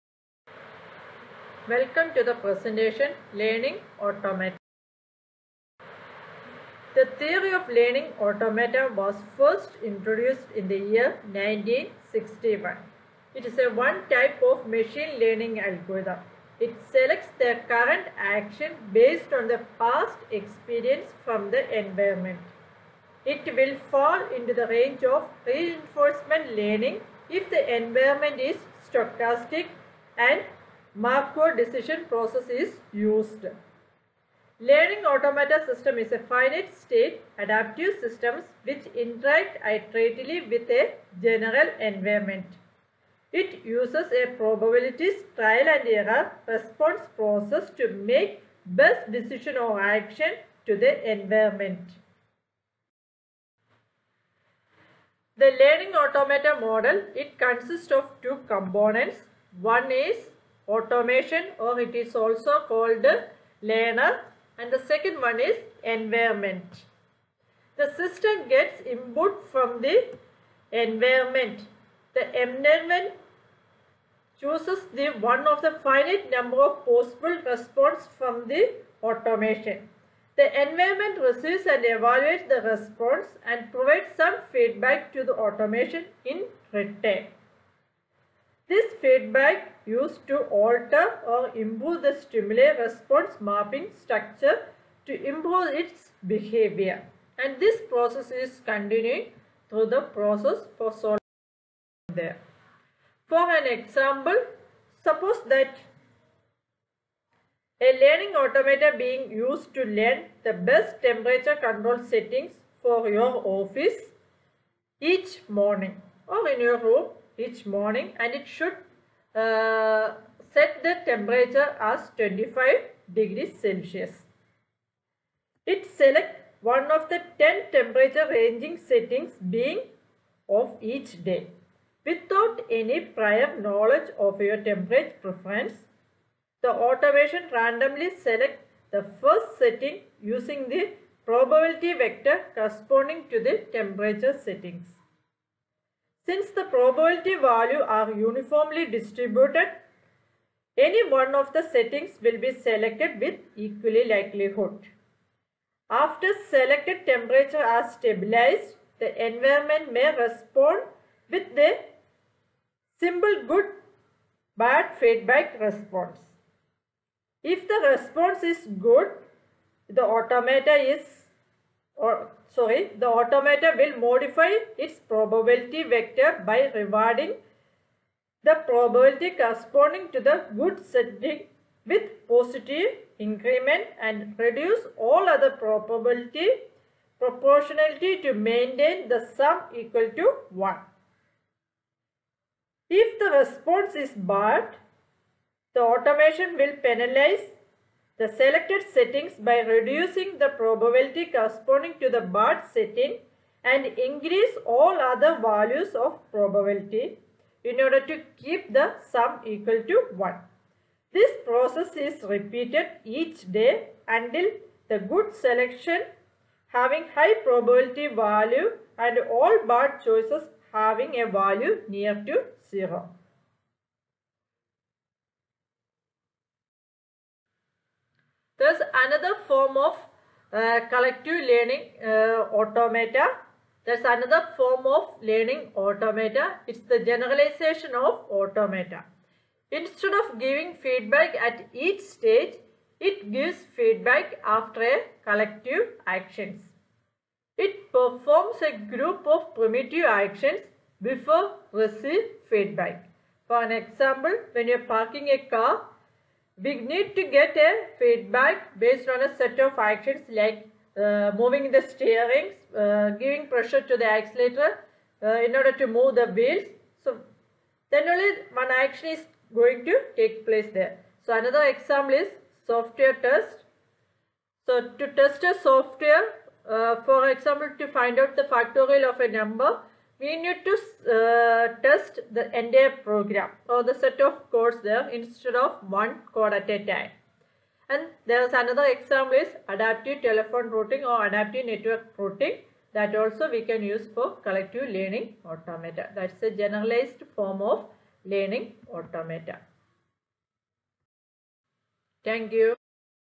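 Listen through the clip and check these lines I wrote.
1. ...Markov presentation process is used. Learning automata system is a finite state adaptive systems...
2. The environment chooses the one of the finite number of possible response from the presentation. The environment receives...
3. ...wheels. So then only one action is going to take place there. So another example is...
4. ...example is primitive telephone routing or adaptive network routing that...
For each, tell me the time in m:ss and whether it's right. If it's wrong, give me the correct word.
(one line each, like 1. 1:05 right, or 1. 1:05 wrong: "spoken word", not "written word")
1. 0:30 wrong: "decision", not "presentation"
2. 1:12 wrong: "automation", not "presentation"
3. 4:26 right
4. 4:48 wrong: "adaptive", not "primitive".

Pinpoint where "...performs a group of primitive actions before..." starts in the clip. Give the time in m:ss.
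4:07.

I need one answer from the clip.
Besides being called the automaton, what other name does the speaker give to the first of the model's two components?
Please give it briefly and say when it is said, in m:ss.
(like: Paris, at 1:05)
learner, at 1:03.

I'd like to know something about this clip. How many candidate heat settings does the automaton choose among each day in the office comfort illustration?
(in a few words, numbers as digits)
10.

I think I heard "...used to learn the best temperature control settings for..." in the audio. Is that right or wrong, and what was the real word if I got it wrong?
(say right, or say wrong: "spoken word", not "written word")
right.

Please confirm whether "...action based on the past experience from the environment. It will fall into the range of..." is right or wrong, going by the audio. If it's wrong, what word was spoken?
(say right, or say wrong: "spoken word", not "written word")
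right.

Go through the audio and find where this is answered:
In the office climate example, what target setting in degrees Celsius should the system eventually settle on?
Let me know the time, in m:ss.
2:02.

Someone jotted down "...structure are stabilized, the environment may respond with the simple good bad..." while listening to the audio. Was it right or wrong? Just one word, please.
wrong.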